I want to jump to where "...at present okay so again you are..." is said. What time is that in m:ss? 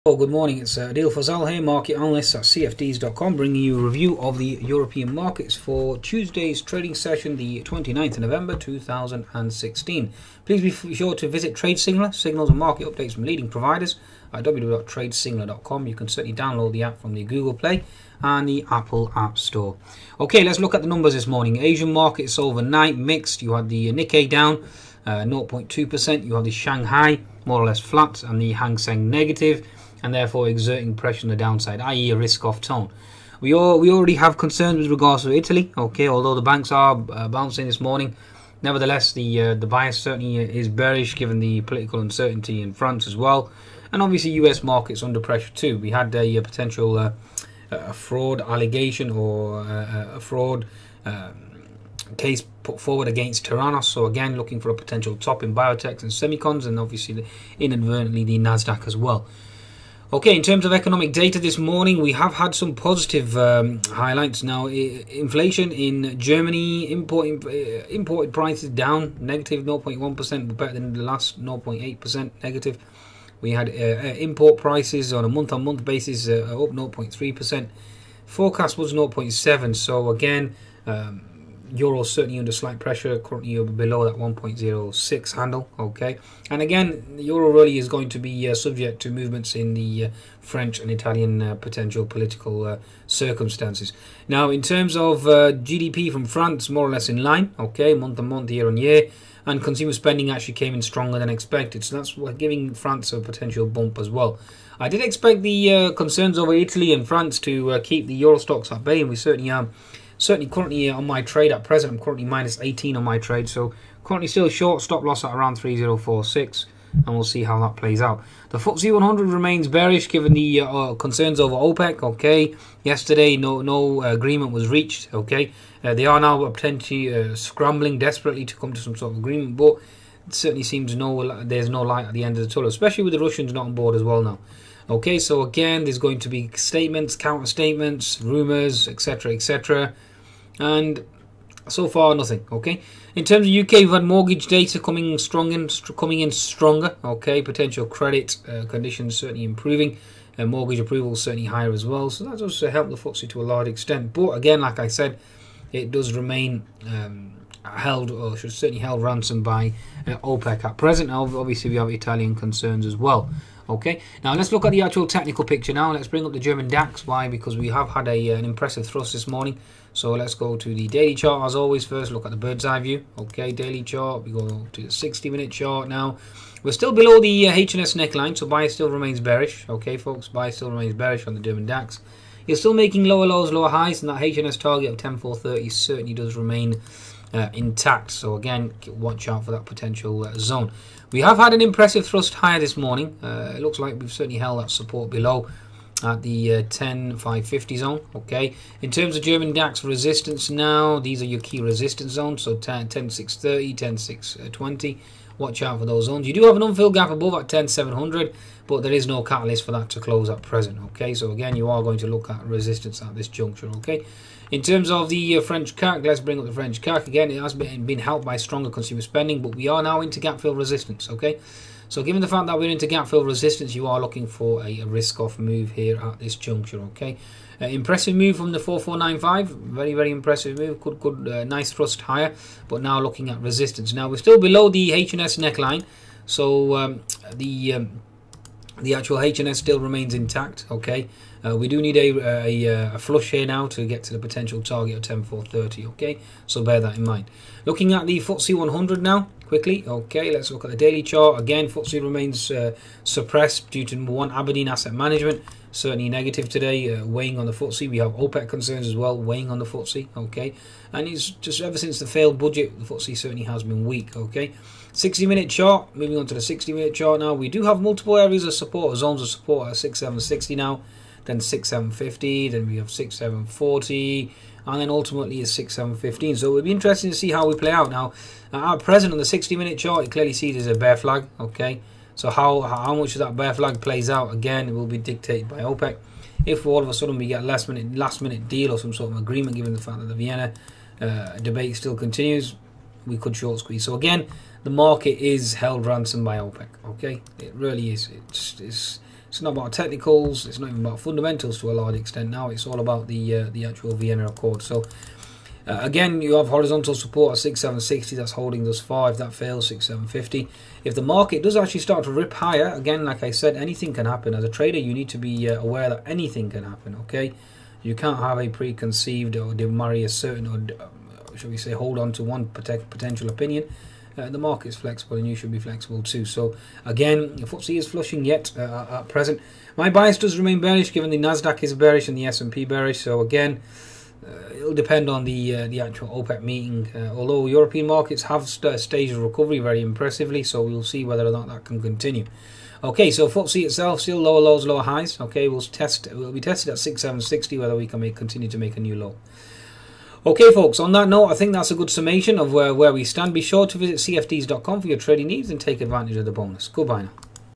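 3:30.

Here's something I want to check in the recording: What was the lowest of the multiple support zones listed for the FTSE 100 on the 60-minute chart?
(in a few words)
6715.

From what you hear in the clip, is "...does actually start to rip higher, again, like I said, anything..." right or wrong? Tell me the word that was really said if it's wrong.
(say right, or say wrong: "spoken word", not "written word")
right.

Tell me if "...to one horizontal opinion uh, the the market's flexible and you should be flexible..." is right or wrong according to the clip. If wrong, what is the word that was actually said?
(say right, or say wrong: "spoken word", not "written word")
wrong: "potential", not "horizontal".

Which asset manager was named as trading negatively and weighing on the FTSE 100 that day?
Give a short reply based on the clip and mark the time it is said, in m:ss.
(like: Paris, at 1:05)
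Aberdeen Asset Management, at 4:14.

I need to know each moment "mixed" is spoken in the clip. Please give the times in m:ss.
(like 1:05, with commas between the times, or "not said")
0:22.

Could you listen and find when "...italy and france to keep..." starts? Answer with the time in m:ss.
1:46.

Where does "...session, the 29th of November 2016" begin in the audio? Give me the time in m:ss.
0:06.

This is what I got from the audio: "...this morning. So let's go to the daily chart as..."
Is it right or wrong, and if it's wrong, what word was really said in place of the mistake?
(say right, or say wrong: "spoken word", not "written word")
right.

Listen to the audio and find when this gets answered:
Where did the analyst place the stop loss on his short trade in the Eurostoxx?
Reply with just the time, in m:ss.
1:55.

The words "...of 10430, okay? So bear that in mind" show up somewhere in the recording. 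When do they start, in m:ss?
4:04.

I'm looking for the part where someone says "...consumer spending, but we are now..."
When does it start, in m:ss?
3:38.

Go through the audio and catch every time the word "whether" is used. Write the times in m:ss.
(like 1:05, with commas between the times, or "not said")
5:41, 5:47.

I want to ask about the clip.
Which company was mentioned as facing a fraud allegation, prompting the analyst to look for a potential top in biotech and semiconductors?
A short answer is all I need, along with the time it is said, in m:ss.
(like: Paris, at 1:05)
Theranos, at 0:53.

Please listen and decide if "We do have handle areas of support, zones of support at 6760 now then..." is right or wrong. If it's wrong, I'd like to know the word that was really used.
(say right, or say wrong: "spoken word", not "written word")
wrong: "multiple", not "handle".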